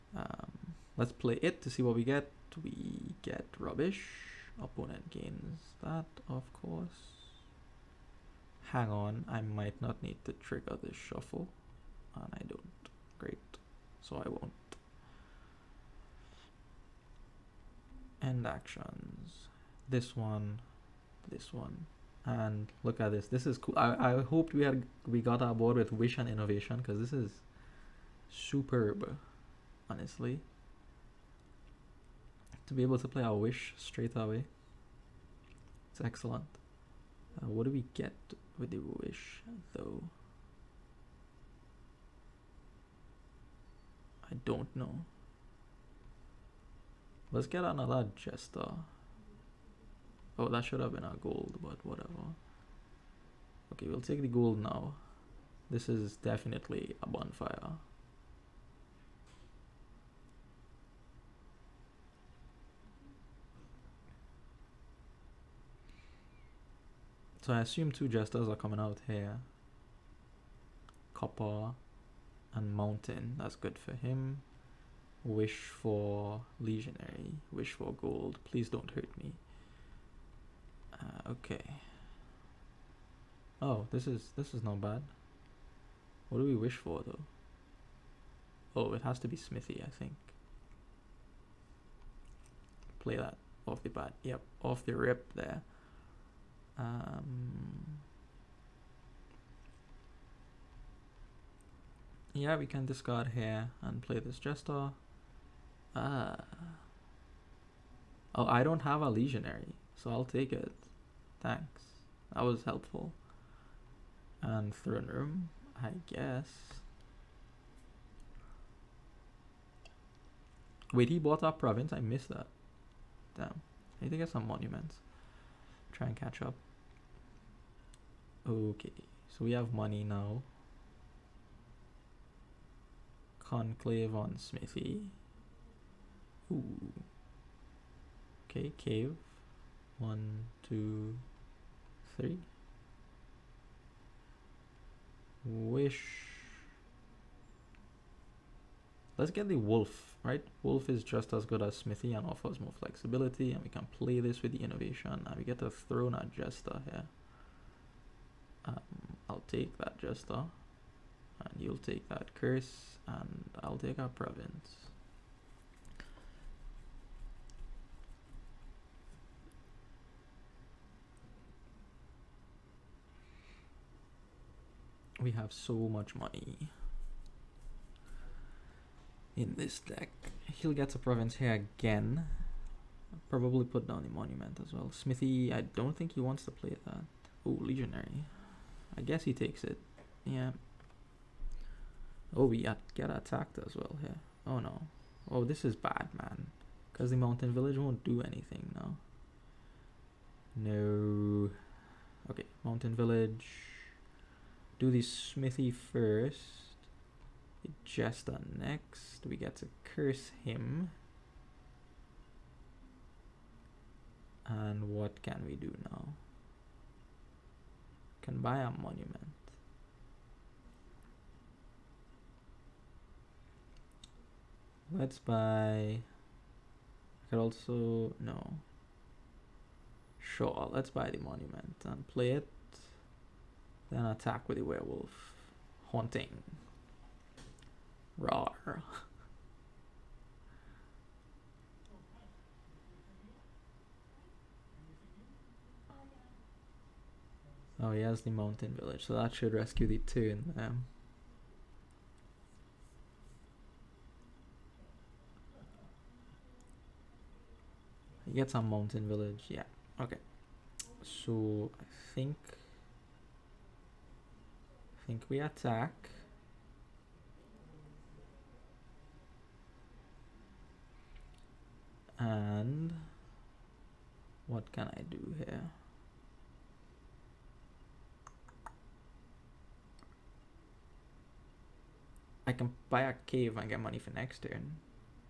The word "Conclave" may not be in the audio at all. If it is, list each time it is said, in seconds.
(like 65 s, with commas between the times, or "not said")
133 s.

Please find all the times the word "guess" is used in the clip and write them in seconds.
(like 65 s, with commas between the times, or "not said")
116 s, 189 s.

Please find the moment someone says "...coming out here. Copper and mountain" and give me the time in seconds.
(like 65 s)
68 s.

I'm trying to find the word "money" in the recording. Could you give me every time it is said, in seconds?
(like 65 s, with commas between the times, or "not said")
129 s, 176 s, 283 s.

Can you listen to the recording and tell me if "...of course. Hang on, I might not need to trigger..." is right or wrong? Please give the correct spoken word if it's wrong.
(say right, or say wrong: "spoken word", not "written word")
right.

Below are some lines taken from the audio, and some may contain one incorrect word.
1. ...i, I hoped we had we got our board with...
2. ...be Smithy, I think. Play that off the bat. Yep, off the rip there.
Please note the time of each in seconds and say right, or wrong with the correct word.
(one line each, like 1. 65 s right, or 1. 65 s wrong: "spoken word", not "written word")
1. 23 s right
2. 89 s right.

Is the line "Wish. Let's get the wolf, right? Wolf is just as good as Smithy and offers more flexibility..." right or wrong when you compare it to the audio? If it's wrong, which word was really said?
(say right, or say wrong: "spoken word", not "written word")
right.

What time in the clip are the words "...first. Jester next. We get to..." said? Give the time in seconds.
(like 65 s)
205 s.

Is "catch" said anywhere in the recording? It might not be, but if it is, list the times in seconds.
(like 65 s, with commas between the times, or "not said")
126 s.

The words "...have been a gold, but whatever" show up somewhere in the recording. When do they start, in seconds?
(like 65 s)
50 s.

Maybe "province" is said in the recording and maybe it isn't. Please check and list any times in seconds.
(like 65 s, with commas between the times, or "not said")
121 s, 164 s, 180 s.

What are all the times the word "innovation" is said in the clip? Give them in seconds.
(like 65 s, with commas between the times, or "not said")
26 s, 154 s.